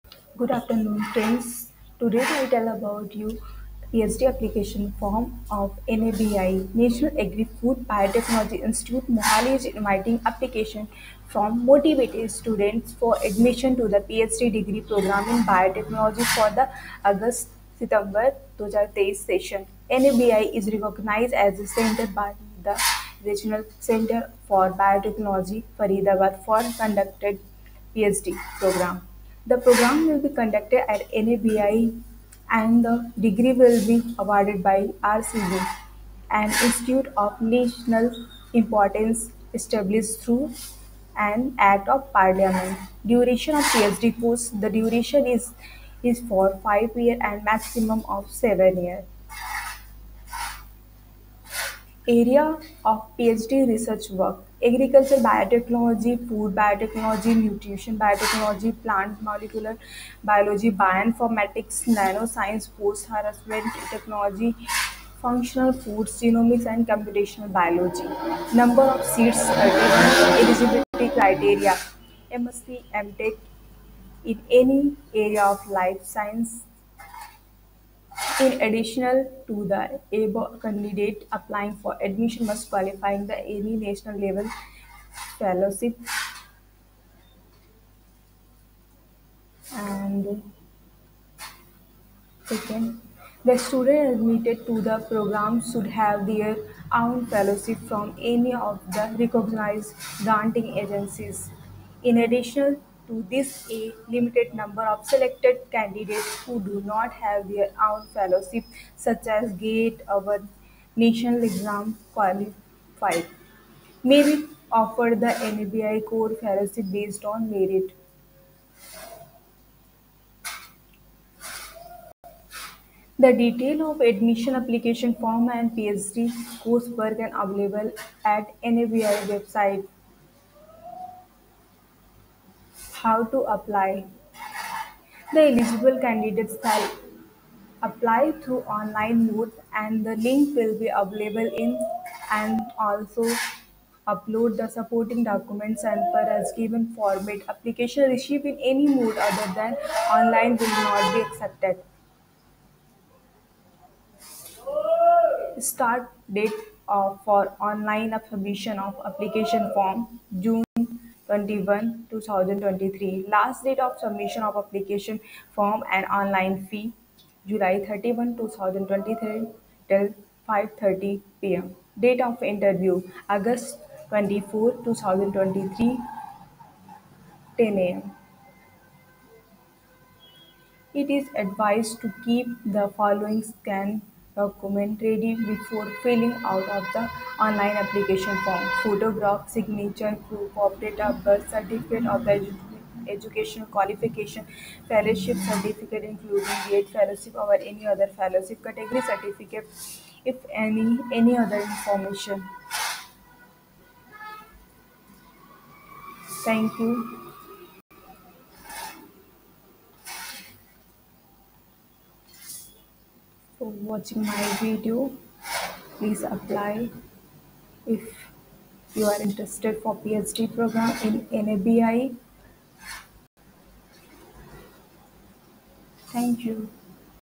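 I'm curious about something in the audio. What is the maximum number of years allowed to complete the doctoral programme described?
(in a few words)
7.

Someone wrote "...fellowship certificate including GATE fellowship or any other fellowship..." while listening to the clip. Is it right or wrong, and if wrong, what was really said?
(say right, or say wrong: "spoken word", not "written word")
right.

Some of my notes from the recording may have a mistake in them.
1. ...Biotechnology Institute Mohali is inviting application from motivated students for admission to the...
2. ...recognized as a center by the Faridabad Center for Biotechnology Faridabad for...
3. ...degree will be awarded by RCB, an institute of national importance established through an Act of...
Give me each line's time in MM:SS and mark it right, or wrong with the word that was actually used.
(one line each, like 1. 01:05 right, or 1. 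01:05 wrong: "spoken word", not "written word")
1. 00:07 right
2. 00:20 wrong: "Regional", not "Faridabad"
3. 00:33 right.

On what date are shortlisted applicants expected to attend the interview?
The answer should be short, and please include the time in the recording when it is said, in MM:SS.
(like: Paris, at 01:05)
August 24, 2023, at 02:53.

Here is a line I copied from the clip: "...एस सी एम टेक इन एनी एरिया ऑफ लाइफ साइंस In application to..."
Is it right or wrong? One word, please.
wrong.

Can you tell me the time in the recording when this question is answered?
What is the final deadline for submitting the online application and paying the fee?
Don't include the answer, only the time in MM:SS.
02:47.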